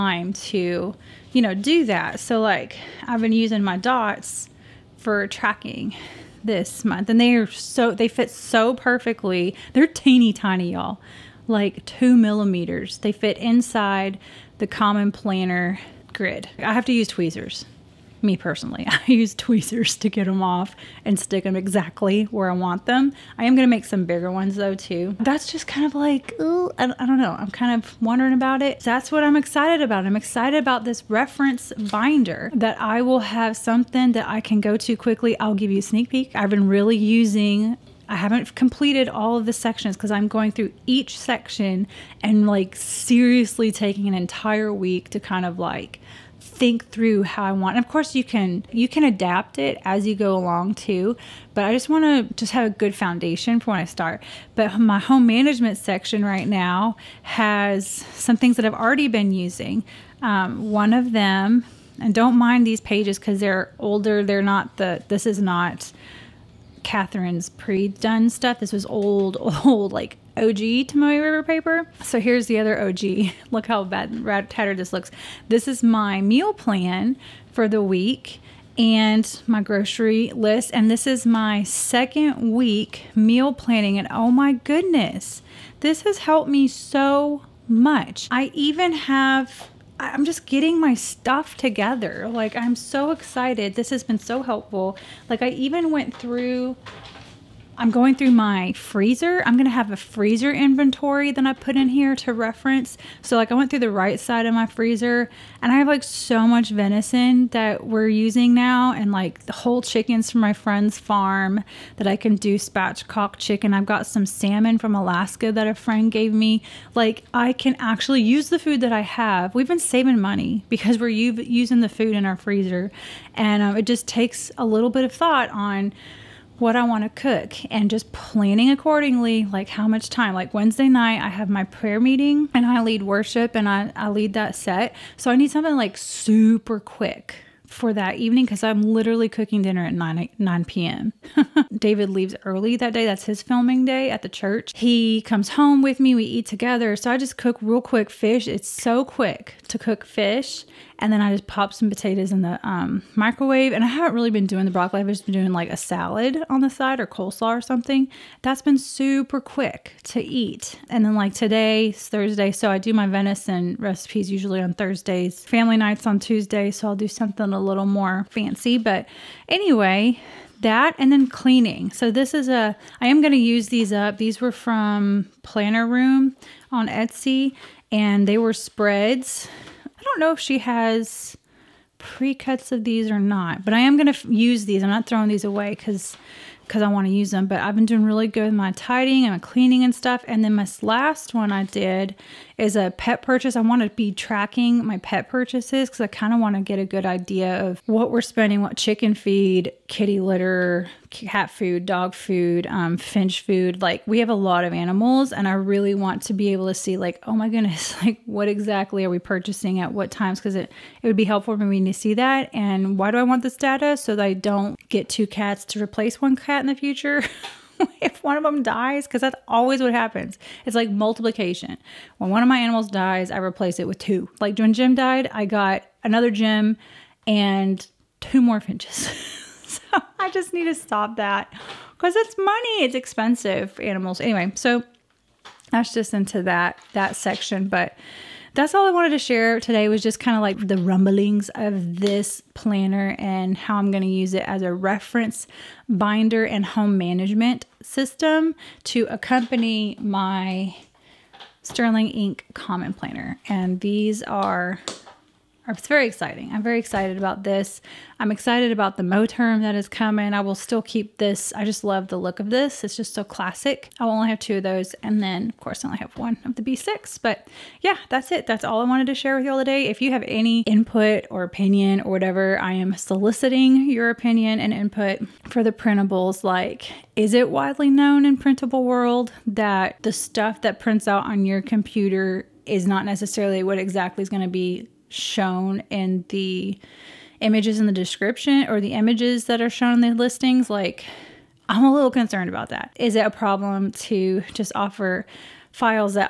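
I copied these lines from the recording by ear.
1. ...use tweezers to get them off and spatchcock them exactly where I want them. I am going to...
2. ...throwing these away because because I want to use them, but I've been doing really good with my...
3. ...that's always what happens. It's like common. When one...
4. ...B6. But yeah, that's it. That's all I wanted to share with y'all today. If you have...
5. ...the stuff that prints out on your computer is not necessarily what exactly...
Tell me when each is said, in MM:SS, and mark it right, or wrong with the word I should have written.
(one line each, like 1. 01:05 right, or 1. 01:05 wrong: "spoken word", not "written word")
1. 00:19 wrong: "stick", not "spatchcock"
2. 03:05 right
3. 03:39 wrong: "multiplication", not "common"
4. 04:26 right
5. 04:40 right.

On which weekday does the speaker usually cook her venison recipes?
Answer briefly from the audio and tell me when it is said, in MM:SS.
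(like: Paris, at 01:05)
Thursday, at 02:44.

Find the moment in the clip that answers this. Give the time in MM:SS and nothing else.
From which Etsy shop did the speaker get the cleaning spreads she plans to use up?
02:55.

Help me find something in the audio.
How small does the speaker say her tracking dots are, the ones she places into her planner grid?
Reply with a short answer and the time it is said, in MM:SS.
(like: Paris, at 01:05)
2 millimeters, at 00:11.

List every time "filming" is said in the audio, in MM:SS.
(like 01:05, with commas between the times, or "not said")
02:23.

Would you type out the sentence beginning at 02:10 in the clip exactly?
Like Wednesday night, I have my prayer meeting and I lead worship and I, I lead that set.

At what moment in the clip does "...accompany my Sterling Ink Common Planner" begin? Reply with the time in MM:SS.
04:09.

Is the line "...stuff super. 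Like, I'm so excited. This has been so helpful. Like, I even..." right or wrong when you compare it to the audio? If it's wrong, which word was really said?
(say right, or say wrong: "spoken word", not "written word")
wrong: "together", not "super".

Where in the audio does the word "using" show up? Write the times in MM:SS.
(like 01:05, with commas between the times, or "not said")
00:03, 00:36, 00:59, 01:48, 02:01.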